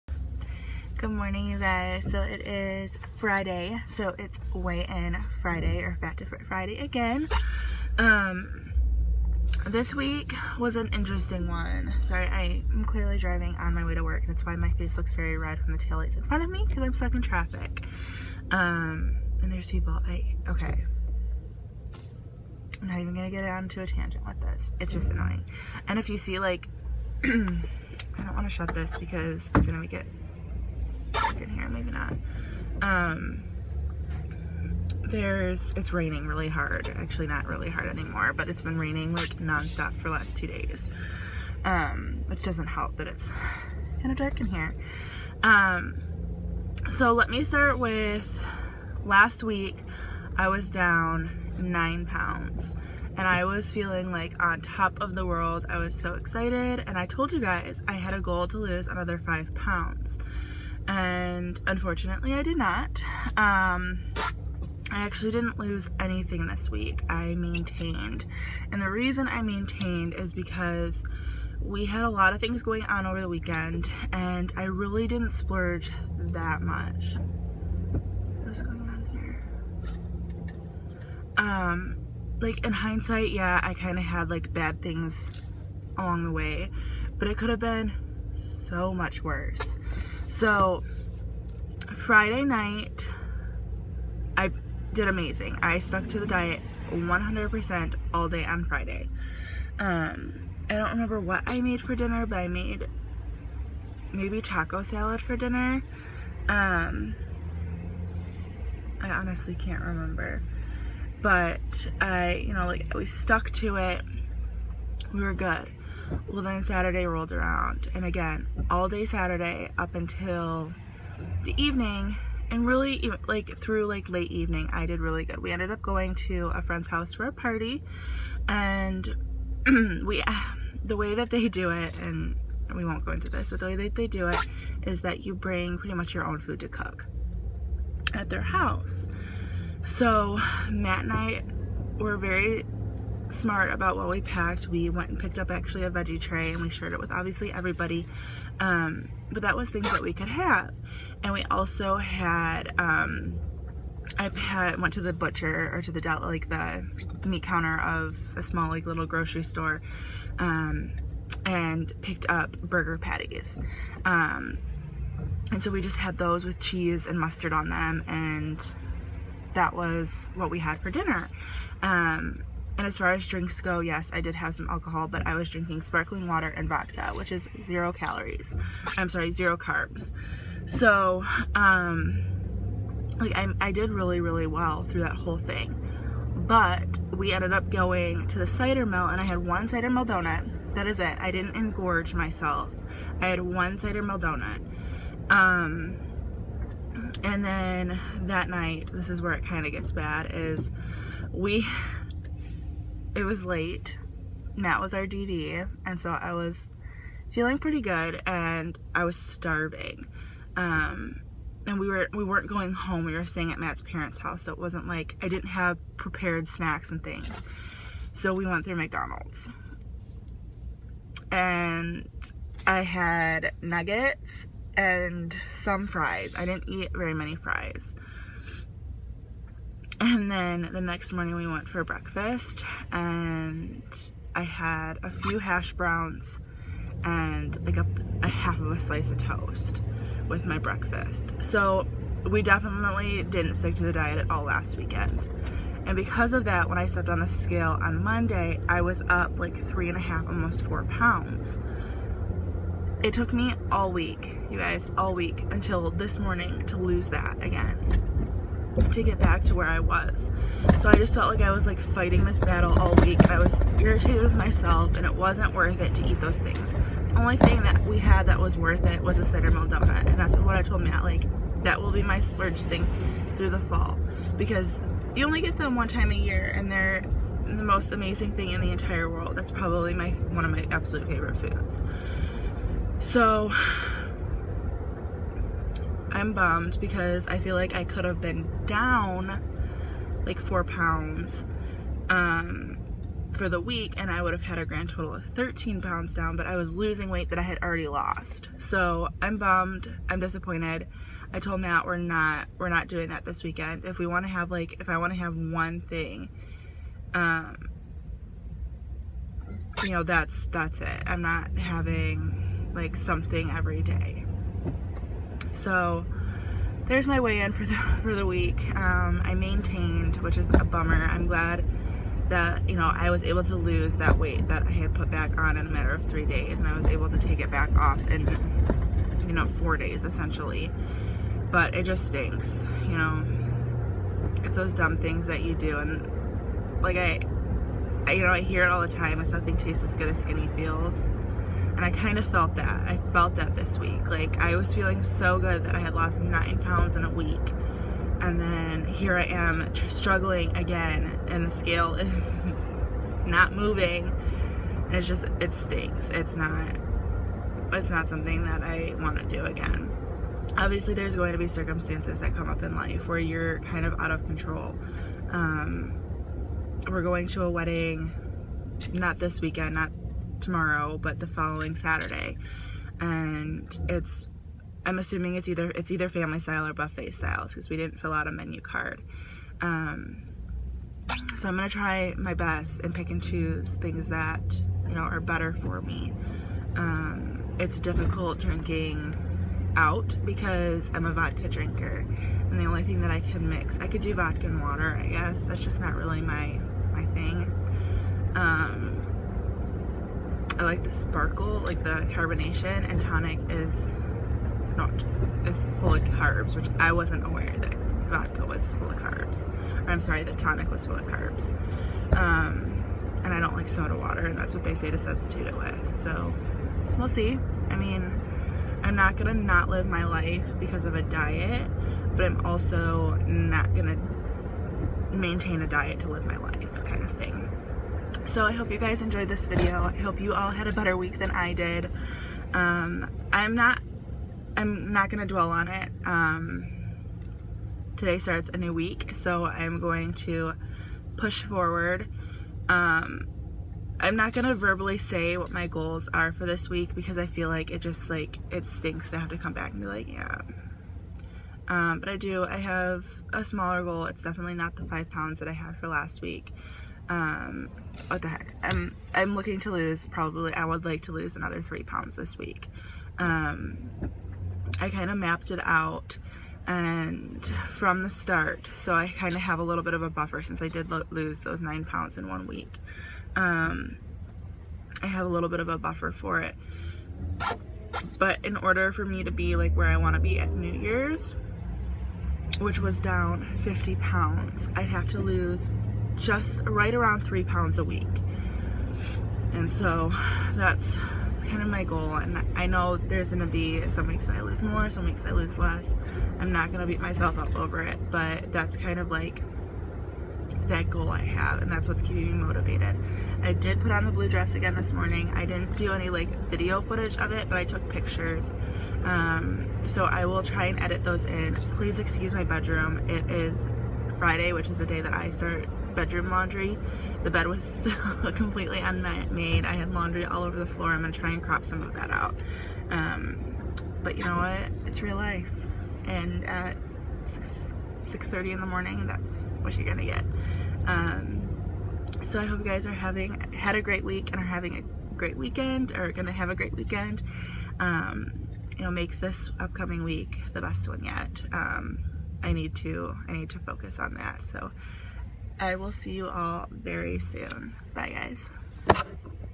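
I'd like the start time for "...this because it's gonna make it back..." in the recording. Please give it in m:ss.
0:28.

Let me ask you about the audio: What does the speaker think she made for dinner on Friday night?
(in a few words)
taco salad.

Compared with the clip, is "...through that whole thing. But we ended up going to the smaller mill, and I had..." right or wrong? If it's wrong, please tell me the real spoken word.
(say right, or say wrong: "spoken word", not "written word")
wrong: "cider", not "smaller".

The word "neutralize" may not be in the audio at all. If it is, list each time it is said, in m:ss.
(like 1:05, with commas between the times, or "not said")
not said.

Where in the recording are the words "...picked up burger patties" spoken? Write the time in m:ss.
2:42.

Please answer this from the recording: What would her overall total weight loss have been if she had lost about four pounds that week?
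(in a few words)
13 pounds.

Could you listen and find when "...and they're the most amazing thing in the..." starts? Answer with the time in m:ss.
4:36.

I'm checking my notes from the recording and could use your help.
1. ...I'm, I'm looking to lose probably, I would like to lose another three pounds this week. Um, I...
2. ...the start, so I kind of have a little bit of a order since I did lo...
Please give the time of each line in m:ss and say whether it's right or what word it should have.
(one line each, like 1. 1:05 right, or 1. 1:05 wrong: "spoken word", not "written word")
1. 7:38 right
2. 7:48 wrong: "buffer", not "order".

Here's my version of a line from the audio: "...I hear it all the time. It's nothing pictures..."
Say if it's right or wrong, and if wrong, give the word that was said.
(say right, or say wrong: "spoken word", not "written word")
wrong: "tastes", not "pictures".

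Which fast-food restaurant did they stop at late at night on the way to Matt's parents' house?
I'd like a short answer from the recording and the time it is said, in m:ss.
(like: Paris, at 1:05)
McDonald's, at 3:38.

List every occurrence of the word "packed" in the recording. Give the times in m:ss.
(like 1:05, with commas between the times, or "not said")
2:24.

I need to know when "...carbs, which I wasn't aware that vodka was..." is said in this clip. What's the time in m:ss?
6:46.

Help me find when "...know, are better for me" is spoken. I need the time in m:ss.
6:24.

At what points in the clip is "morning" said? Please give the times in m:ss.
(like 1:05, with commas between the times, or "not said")
0:01, 3:51, 4:16, 8:24, 8:48.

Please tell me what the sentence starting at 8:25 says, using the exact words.
I didn't do any like video footage of it, but I took pictures.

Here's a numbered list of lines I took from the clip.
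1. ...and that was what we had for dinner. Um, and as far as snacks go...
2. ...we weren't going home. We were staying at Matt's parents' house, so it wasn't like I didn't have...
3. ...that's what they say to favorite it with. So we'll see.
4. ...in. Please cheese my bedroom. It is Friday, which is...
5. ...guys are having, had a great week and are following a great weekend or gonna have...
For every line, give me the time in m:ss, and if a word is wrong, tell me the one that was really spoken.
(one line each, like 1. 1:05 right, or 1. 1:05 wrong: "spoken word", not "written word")
1. 2:48 wrong: "drinks", not "snacks"
2. 3:32 right
3. 6:54 wrong: "substitute", not "favorite"
4. 8:31 wrong: "excuse", not "cheese"
5. 8:52 wrong: "having", not "following".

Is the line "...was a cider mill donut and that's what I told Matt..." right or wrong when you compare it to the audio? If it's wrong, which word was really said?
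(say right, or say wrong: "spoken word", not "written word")
right.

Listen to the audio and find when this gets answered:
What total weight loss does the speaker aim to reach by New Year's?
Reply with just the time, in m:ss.
8:03.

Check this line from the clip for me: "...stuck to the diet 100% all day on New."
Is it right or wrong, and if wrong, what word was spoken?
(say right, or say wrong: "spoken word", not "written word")
wrong: "Friday", not "New".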